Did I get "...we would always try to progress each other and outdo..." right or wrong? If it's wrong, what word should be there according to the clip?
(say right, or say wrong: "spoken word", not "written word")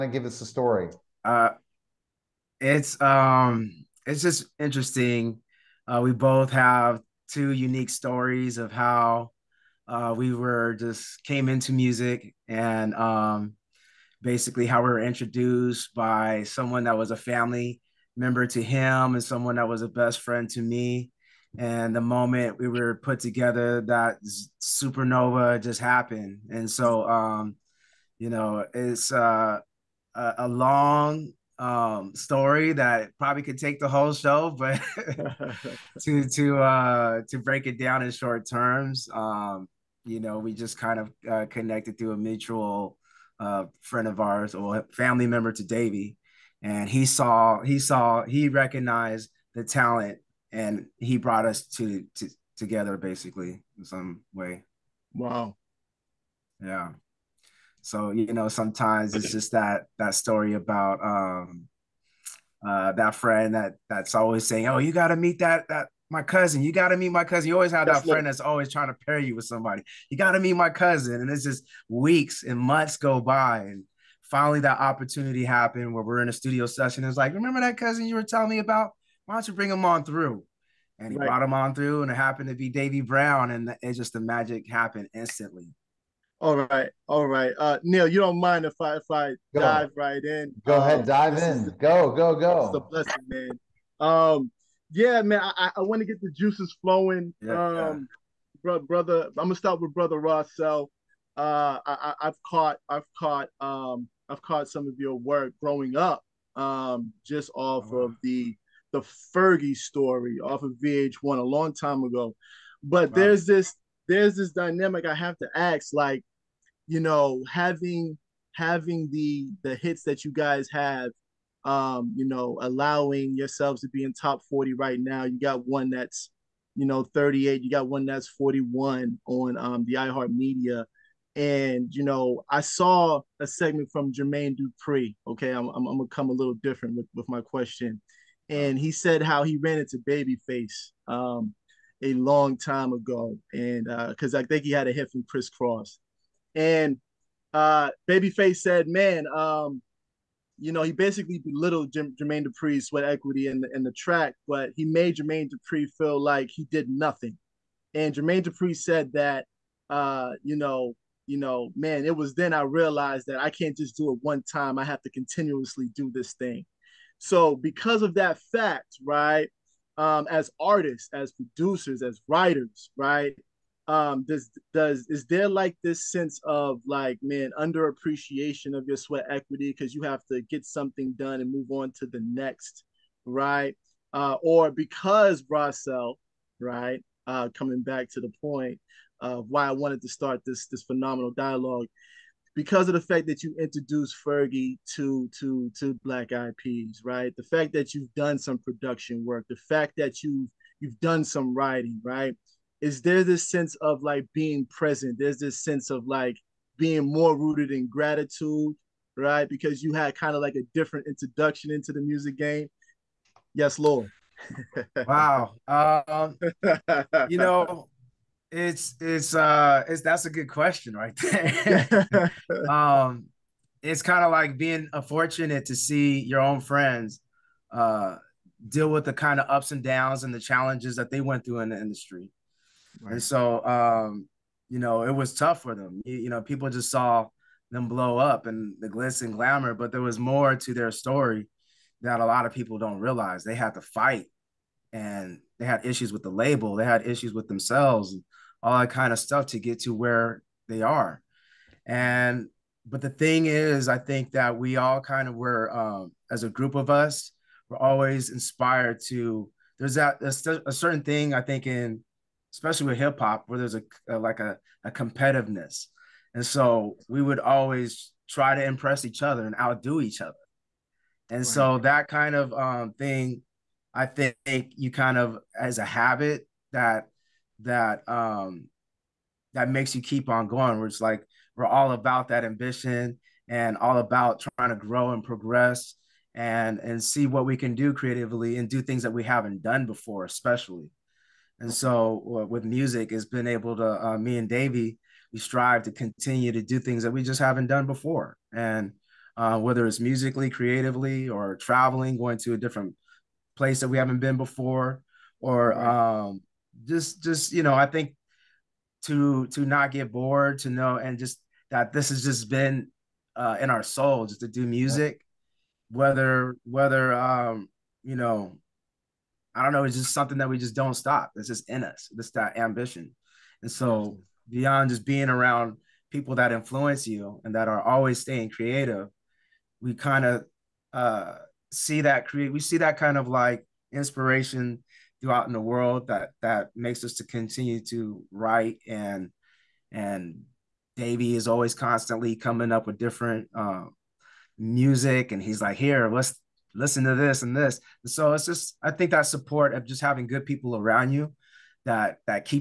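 wrong: "impress", not "progress".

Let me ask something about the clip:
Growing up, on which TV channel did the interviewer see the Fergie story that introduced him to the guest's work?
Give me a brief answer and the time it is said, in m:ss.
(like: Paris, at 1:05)
VH1, at 1:50.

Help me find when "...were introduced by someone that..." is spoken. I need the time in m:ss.
0:14.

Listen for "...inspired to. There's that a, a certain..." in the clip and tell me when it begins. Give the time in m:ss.
4:18.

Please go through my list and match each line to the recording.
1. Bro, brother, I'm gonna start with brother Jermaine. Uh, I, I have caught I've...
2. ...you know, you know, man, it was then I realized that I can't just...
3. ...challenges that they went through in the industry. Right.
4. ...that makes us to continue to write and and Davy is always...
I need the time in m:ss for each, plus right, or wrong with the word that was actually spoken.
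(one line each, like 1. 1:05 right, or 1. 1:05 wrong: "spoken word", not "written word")
1. 1:38 wrong: "Rawcel", not "Jermaine"
2. 2:40 right
3. 3:50 right
4. 5:36 right.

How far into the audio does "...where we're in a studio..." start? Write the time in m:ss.
1:15.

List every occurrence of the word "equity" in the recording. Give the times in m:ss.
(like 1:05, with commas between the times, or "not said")
2:33, 2:59.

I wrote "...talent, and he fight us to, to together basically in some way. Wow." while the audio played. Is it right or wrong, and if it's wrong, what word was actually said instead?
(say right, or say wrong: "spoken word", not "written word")
wrong: "brought", not "fight".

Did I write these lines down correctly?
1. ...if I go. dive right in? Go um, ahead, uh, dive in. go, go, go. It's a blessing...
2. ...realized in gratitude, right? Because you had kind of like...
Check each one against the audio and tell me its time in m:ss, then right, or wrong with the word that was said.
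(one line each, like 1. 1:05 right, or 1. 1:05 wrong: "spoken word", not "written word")
1. 1:28 right
2. 3:27 wrong: "rooted", not "realized".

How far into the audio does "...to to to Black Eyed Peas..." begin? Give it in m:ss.
3:14.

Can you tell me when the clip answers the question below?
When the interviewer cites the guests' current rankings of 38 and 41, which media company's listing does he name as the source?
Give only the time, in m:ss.
2:09.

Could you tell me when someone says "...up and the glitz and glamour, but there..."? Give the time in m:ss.
3:58.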